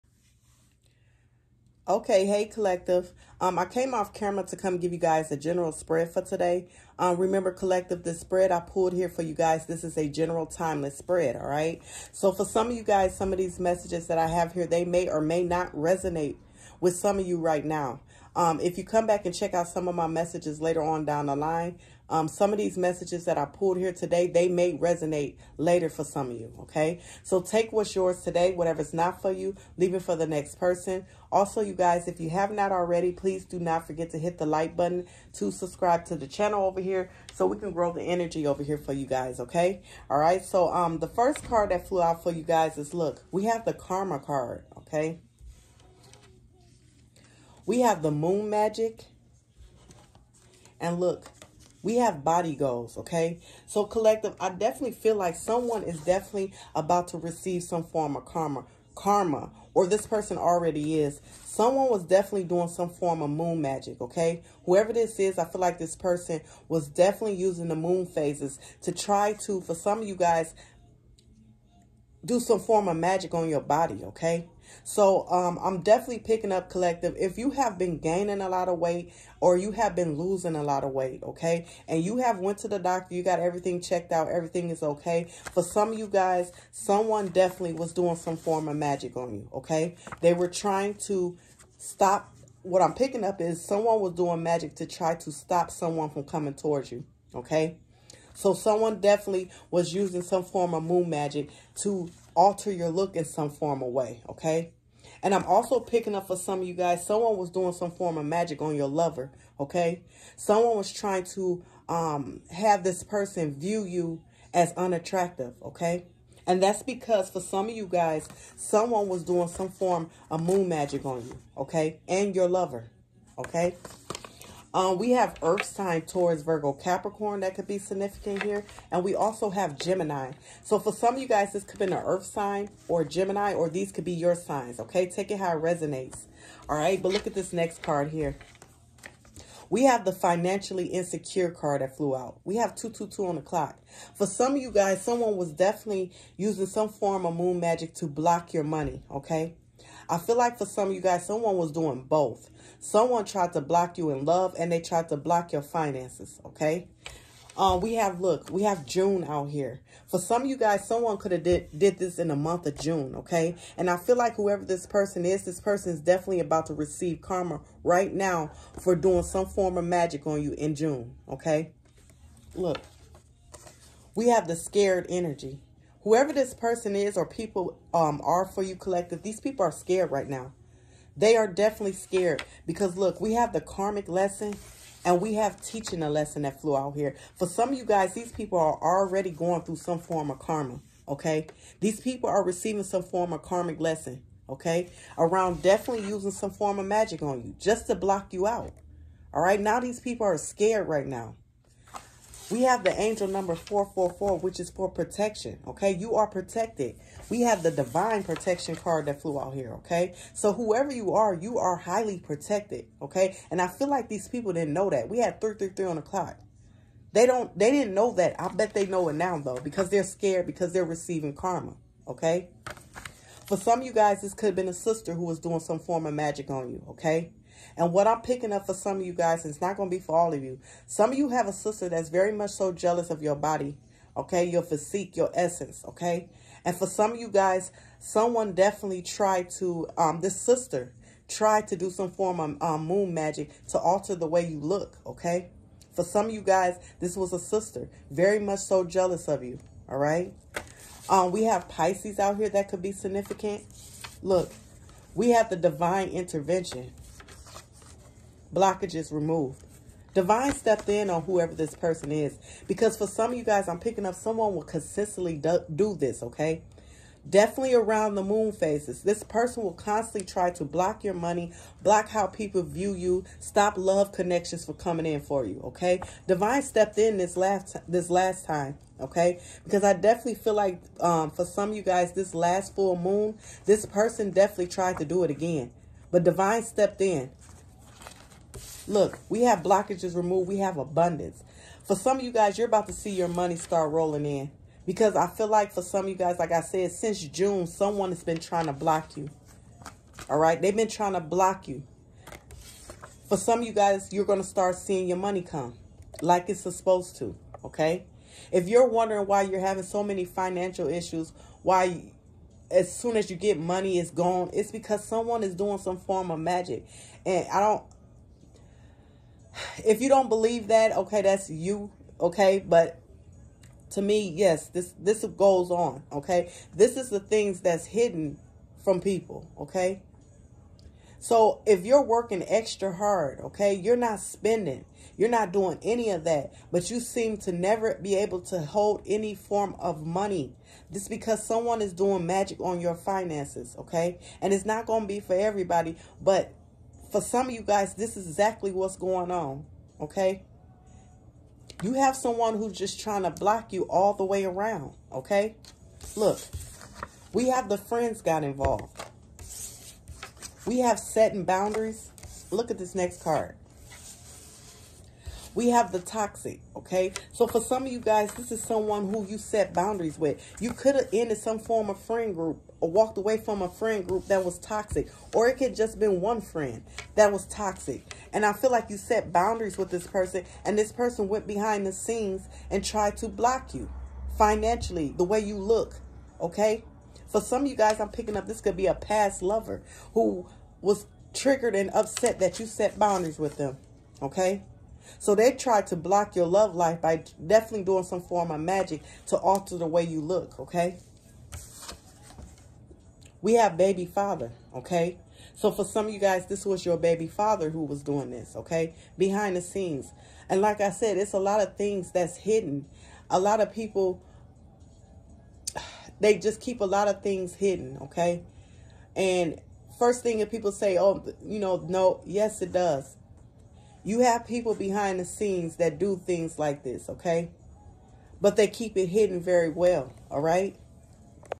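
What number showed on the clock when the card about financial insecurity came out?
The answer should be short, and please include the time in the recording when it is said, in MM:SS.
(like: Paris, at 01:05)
222, at 02:22.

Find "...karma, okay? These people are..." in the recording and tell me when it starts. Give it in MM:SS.
03:10.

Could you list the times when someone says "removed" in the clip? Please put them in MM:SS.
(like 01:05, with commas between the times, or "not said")
04:19, 04:50.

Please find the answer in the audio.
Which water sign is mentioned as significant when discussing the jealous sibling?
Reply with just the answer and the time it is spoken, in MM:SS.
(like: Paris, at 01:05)
Pisces, at 04:11.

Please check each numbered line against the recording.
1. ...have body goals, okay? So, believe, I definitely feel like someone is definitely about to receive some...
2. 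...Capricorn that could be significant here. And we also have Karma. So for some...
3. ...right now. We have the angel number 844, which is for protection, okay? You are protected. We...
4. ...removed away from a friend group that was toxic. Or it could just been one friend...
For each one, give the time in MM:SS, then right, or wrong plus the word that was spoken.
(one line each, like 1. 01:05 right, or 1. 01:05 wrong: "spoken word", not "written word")
1. 00:51 wrong: "collective", not "believe"
2. 02:06 wrong: "Gemini", not "Karma"
3. 03:20 wrong: "444", not "844"
4. 06:12 wrong: "walked", not "removed".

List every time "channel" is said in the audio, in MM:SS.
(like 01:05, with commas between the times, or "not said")
00:36.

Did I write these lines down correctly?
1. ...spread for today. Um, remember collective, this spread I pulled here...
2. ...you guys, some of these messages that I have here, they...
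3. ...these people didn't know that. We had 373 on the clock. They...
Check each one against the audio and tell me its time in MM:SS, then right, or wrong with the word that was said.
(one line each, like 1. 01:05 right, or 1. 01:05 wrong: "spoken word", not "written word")
1. 00:05 right
2. 00:12 right
3. 03:34 wrong: "333", not "373".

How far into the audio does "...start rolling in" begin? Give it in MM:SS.
04:53.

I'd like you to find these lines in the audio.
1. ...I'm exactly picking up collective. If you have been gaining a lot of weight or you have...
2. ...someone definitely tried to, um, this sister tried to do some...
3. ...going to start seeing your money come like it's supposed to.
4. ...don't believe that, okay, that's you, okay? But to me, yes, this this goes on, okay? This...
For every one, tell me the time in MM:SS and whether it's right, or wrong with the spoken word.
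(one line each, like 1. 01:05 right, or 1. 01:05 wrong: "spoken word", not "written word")
1. 01:15 wrong: "definitely", not "exactly"
2. 03:57 right
3. 05:04 right
4. 05:20 right.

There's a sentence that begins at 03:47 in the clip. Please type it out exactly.
And what I'm picking up for some of you guys, it's not going to be for all of you.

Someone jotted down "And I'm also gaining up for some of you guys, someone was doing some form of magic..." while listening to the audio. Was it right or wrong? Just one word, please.
wrong.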